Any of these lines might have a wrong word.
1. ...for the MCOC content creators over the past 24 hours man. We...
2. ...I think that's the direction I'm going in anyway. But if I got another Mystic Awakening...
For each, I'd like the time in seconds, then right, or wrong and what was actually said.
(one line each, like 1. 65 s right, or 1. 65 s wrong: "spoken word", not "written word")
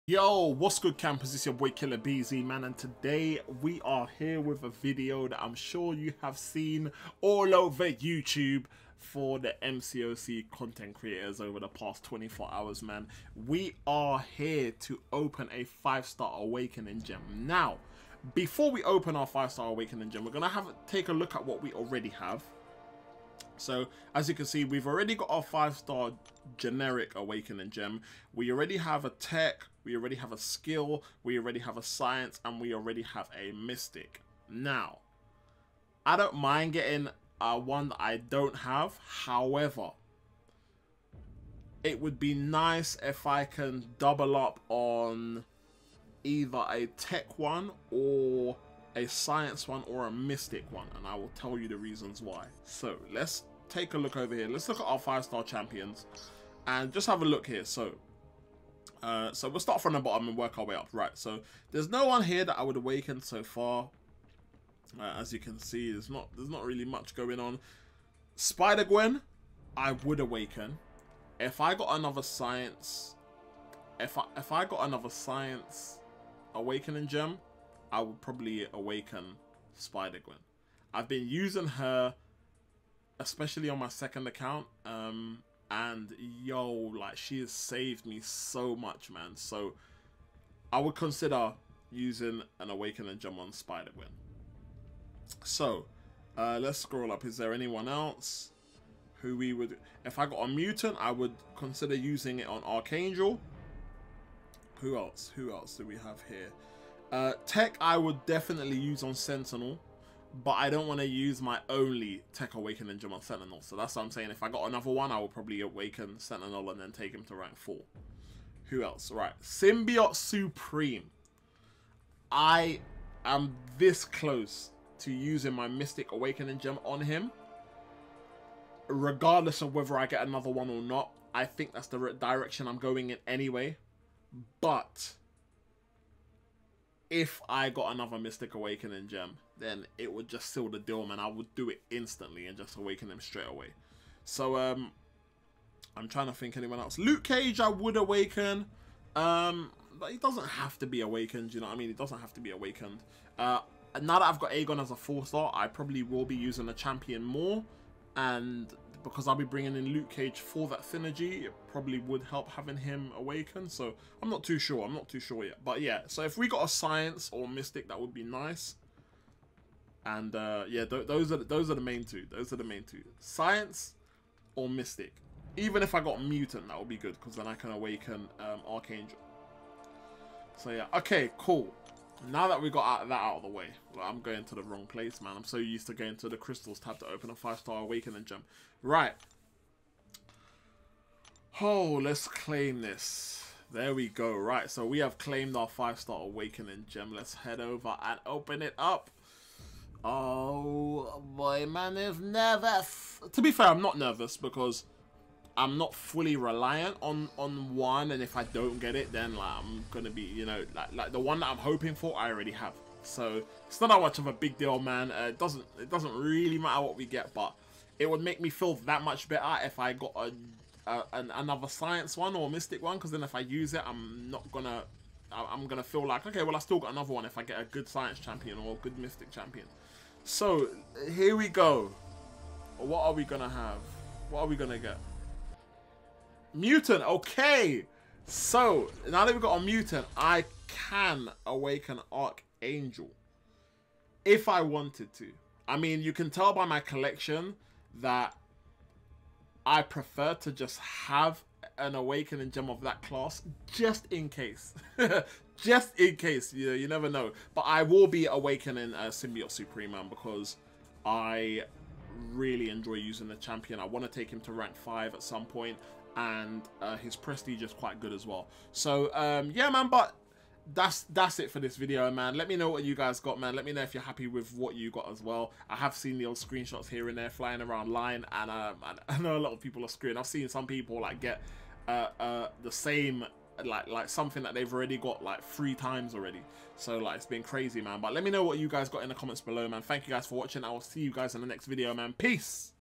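1. 8 s right
2. 131 s right.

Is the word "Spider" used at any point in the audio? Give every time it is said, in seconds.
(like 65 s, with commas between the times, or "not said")
68 s, 79 s, 93 s.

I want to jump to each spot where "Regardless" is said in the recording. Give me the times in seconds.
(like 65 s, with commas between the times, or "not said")
128 s.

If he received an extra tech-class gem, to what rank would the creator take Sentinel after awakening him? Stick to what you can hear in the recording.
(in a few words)
rank 4.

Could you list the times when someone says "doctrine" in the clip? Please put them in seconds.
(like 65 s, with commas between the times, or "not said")
not said.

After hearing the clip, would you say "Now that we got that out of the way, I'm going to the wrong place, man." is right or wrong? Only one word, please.
right.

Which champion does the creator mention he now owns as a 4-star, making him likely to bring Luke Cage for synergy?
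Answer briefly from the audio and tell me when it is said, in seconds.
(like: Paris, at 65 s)
Aegon, at 154 s.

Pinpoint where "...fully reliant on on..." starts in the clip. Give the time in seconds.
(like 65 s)
205 s.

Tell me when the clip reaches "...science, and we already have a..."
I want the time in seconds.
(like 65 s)
31 s.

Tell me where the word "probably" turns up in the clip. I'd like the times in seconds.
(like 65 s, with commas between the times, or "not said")
78 s, 115 s, 155 s, 161 s.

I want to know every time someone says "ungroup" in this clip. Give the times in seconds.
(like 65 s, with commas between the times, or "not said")
not said.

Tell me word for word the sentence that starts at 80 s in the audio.
I've been using her especially on my second account.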